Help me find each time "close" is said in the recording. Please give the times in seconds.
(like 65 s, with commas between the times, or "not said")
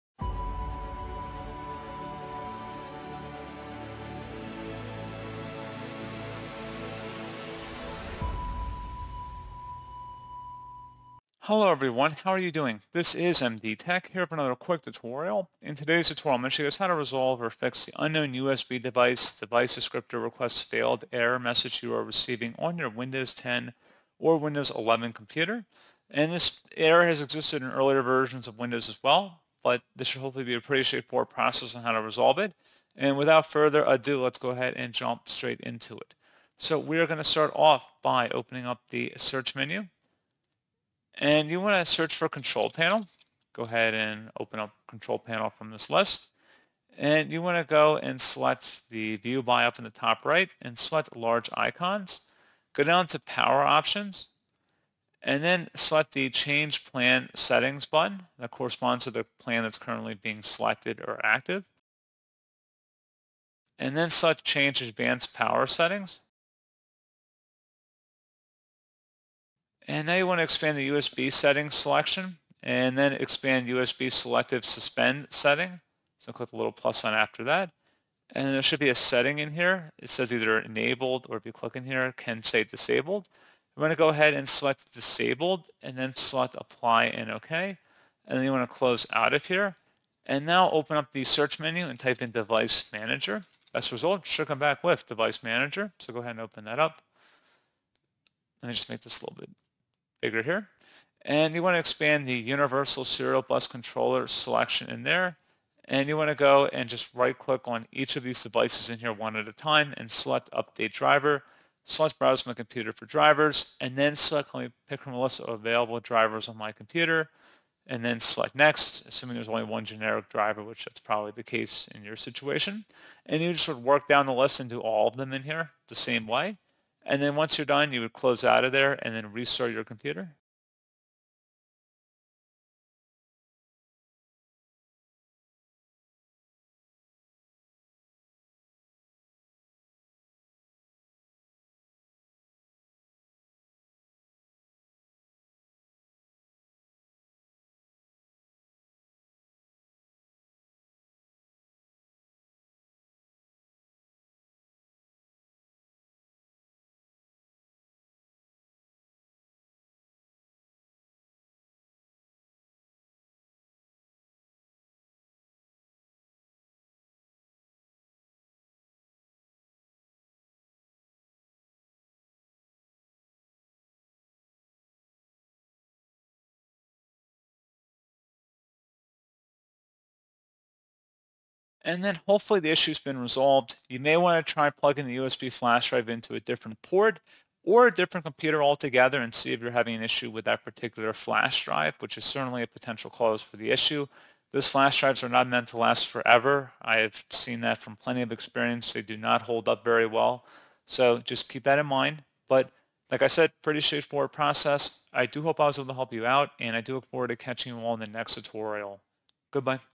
88 s, 128 s.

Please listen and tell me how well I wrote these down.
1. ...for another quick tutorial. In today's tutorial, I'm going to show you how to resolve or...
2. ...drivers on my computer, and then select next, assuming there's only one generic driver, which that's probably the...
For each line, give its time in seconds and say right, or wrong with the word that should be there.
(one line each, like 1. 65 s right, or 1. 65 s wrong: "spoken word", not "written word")
1. 14 s right
2. 115 s right.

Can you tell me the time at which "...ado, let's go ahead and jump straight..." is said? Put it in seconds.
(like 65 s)
33 s.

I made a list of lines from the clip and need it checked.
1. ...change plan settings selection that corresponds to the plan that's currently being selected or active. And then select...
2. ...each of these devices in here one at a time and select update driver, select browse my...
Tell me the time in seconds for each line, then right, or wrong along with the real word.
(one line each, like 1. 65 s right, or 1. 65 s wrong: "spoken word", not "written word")
1. 56 s wrong: "button", not "selection"
2. 107 s right.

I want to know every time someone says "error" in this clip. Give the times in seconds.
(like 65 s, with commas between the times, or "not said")
21 s, 26 s.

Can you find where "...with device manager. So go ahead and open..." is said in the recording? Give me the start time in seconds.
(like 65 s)
94 s.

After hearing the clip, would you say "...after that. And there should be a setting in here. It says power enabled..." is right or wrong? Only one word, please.
wrong.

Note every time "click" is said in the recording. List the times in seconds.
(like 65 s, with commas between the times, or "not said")
76 s, 81 s, 107 s.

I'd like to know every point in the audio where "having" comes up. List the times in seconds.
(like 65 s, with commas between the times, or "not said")
189 s.